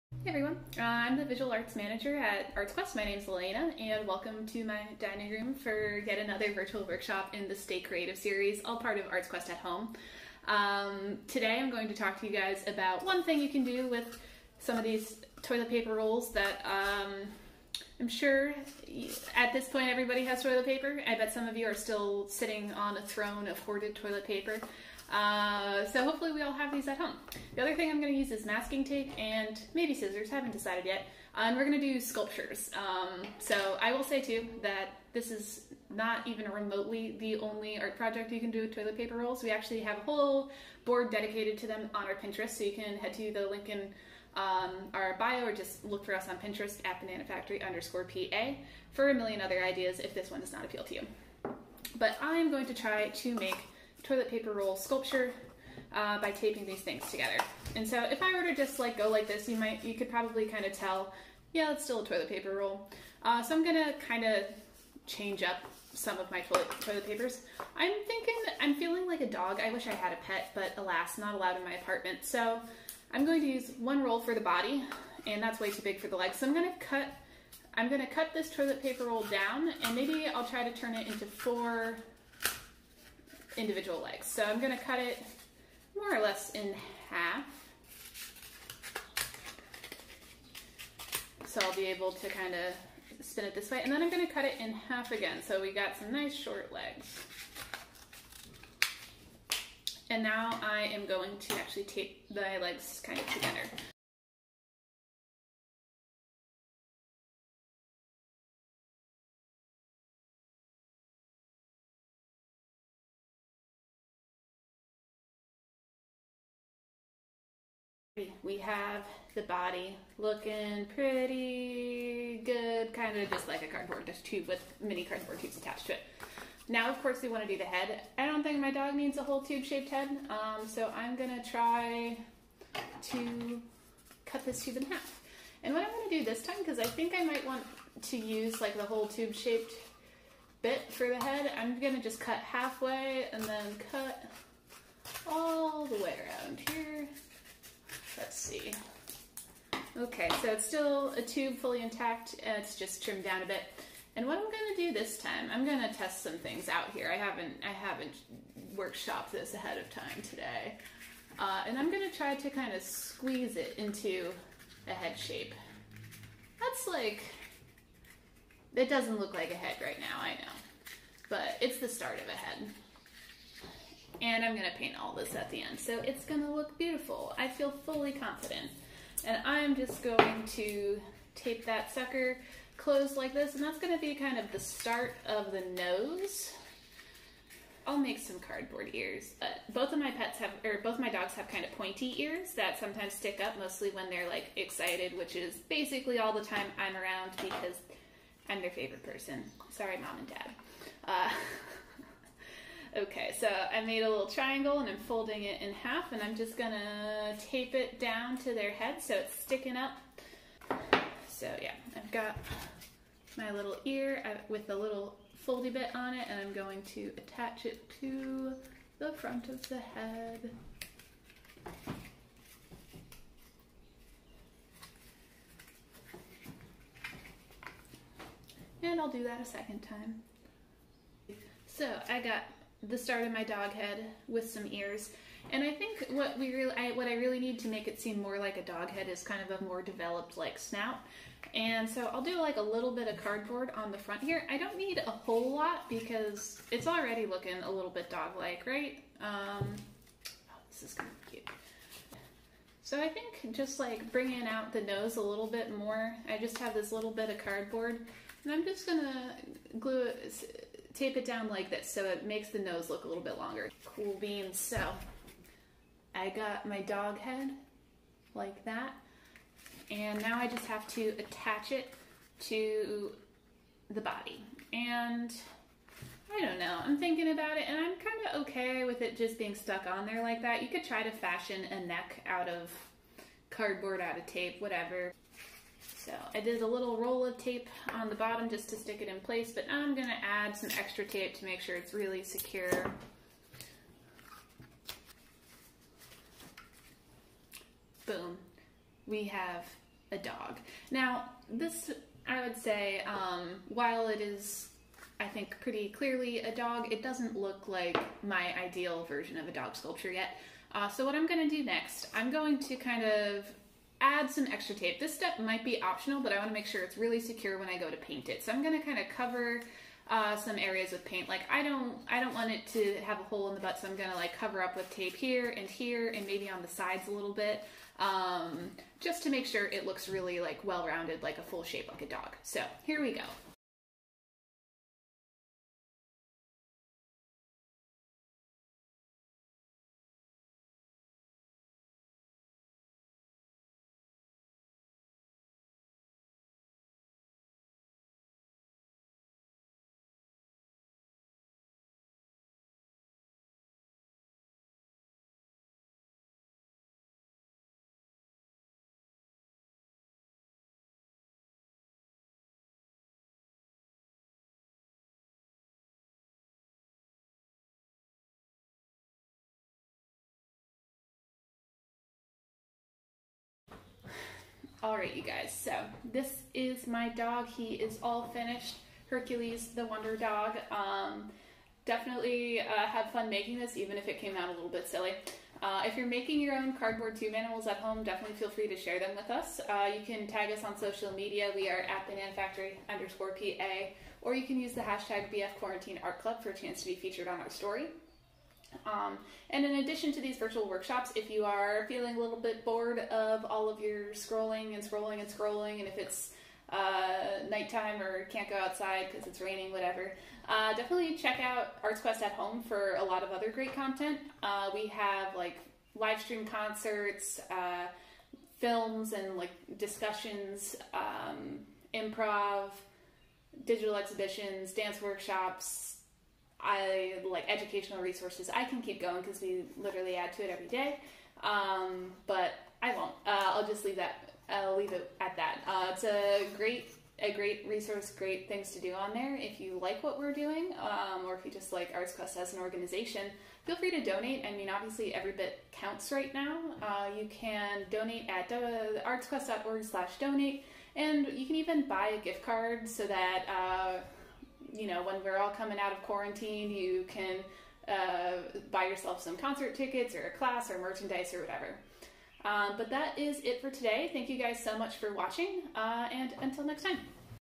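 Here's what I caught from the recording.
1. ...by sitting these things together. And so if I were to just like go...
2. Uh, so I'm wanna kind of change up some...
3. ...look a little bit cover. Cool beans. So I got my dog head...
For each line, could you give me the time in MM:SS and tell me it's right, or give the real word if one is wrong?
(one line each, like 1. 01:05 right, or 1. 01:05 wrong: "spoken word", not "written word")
1. 00:56 wrong: "taping", not "sitting"
2. 01:03 wrong: "gonna", not "wanna"
3. 04:22 wrong: "longer", not "cover".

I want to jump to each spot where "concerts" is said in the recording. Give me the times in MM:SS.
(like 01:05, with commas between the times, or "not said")
06:56, 07:39.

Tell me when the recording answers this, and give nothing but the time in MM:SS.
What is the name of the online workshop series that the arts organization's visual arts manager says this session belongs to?
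00:07.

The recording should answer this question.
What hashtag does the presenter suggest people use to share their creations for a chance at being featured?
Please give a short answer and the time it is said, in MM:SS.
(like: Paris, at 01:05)
BF Quarantine Art Club, at 06:35.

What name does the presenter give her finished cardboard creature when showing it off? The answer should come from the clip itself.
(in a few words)
Hercules.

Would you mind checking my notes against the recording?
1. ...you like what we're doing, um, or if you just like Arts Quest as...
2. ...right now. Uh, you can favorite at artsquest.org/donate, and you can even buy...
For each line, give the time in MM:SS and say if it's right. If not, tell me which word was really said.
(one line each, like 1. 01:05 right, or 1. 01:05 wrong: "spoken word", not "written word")
1. 07:19 right
2. 07:26 wrong: "donate", not "favorite".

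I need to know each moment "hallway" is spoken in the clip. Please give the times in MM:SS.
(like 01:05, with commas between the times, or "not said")
not said.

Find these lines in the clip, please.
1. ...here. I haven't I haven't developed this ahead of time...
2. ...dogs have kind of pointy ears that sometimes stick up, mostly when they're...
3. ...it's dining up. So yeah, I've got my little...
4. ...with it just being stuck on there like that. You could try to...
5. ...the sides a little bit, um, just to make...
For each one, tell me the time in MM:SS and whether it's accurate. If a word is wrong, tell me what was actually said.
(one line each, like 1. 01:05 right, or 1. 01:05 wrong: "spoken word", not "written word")
1. 02:36 wrong: "workshopped", not "developed"
2. 03:11 right
3. 03:29 wrong: "sticking", not "dining"
4. 04:38 right
5. 05:26 right.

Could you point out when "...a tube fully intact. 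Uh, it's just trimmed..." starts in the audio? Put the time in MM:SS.
02:31.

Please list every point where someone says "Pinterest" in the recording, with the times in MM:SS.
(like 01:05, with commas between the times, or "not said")
00:42, 00:46.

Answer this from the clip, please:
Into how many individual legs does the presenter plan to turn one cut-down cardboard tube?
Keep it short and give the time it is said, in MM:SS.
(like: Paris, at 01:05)
4, at 01:21.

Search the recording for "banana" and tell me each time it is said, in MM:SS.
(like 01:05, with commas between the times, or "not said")
00:47, 06:32.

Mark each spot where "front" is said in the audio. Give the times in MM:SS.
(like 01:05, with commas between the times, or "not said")
03:39, 04:03.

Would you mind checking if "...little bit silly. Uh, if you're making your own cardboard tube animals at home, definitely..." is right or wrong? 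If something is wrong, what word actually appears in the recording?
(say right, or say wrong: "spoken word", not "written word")
right.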